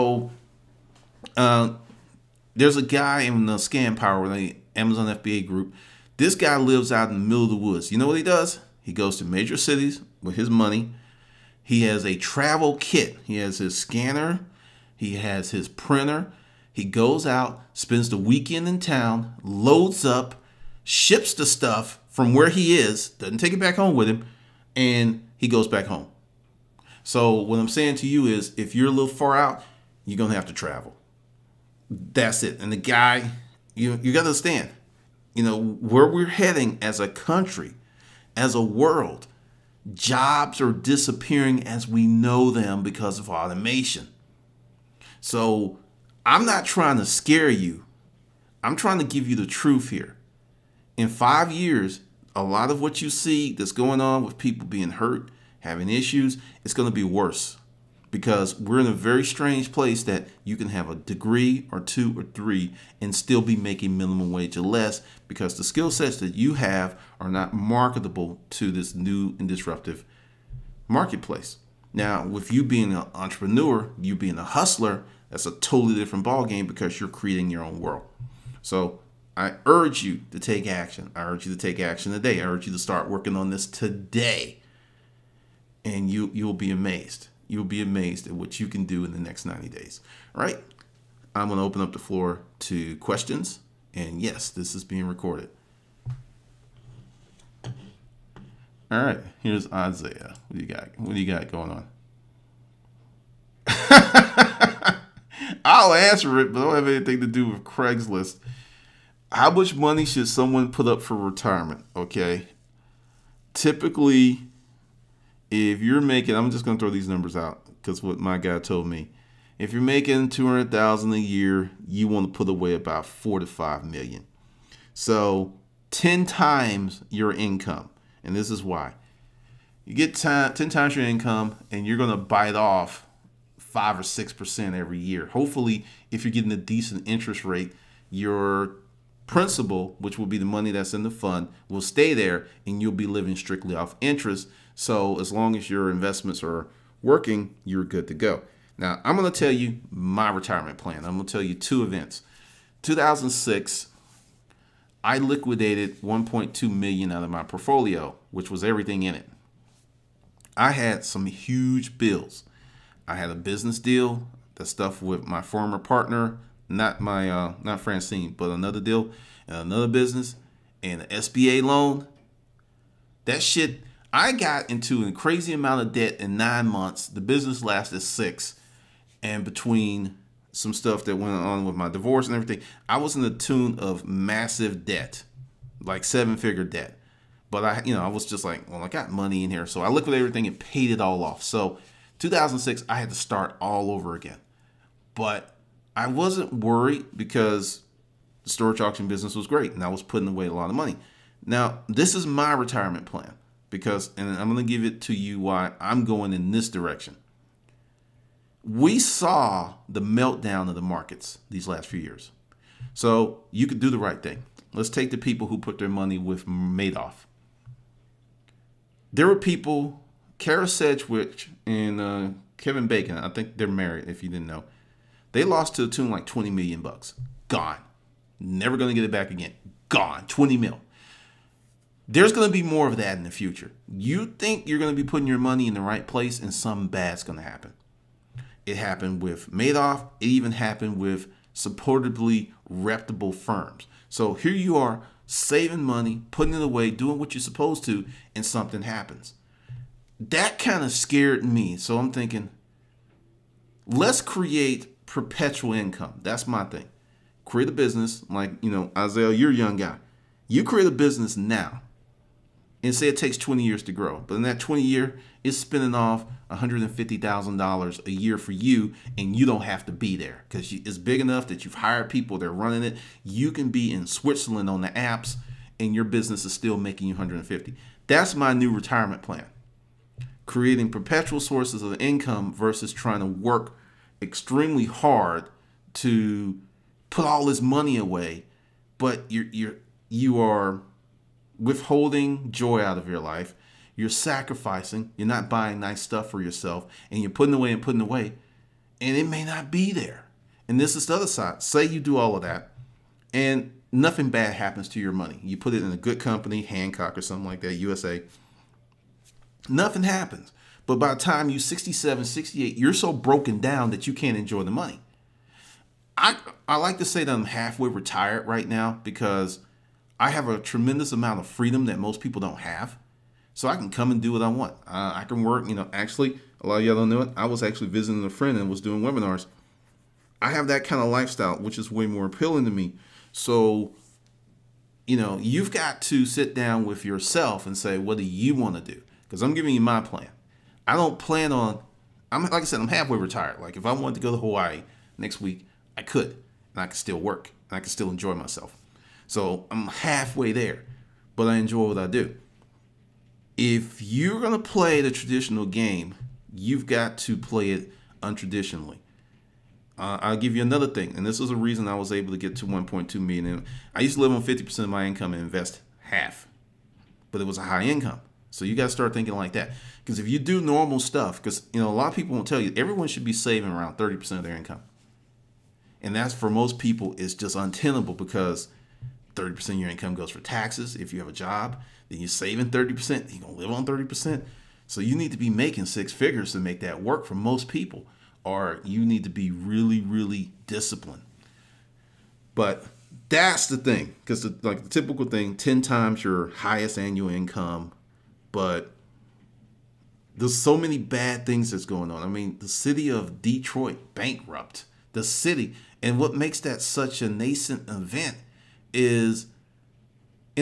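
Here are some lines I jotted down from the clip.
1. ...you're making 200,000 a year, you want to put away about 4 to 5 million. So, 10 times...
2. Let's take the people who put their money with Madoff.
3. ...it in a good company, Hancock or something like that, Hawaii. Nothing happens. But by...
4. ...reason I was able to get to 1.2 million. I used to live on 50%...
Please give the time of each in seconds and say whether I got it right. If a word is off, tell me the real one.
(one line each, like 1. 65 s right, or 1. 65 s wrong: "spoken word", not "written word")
1. 119 s right
2. 214 s right
3. 305 s wrong: "USA", not "Hawaii"
4. 361 s right.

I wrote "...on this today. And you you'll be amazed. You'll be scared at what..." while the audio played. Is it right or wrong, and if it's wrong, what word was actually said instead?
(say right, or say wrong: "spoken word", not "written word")
wrong: "amazed", not "scared".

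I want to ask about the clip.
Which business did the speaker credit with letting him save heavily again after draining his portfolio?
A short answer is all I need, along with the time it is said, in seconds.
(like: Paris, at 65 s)
storage auction business, at 198 s.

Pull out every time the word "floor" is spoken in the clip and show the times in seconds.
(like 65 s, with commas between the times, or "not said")
91 s.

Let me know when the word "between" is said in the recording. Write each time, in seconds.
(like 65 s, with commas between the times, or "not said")
179 s.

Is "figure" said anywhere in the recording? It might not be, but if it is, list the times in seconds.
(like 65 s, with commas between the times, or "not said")
186 s, 386 s.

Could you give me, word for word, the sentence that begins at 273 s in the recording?
You can be in Switzerland on the Alps, and your business is still making you 150.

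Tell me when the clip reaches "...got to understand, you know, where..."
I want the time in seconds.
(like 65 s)
34 s.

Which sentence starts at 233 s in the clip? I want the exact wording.
You think you're going to be putting your money in the right place and something bad's going to happen.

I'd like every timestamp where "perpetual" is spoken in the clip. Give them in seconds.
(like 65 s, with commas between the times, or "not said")
255 s, 280 s.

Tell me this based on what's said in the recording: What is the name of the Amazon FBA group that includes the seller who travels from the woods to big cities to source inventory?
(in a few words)
ScanPower.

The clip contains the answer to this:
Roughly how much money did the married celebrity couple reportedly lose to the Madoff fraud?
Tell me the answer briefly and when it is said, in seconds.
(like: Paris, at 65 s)
20 million, at 226 s.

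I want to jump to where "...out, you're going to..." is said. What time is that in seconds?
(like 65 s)
29 s.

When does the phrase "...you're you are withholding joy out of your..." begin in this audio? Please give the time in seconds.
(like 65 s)
289 s.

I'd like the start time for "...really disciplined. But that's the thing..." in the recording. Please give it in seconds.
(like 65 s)
389 s.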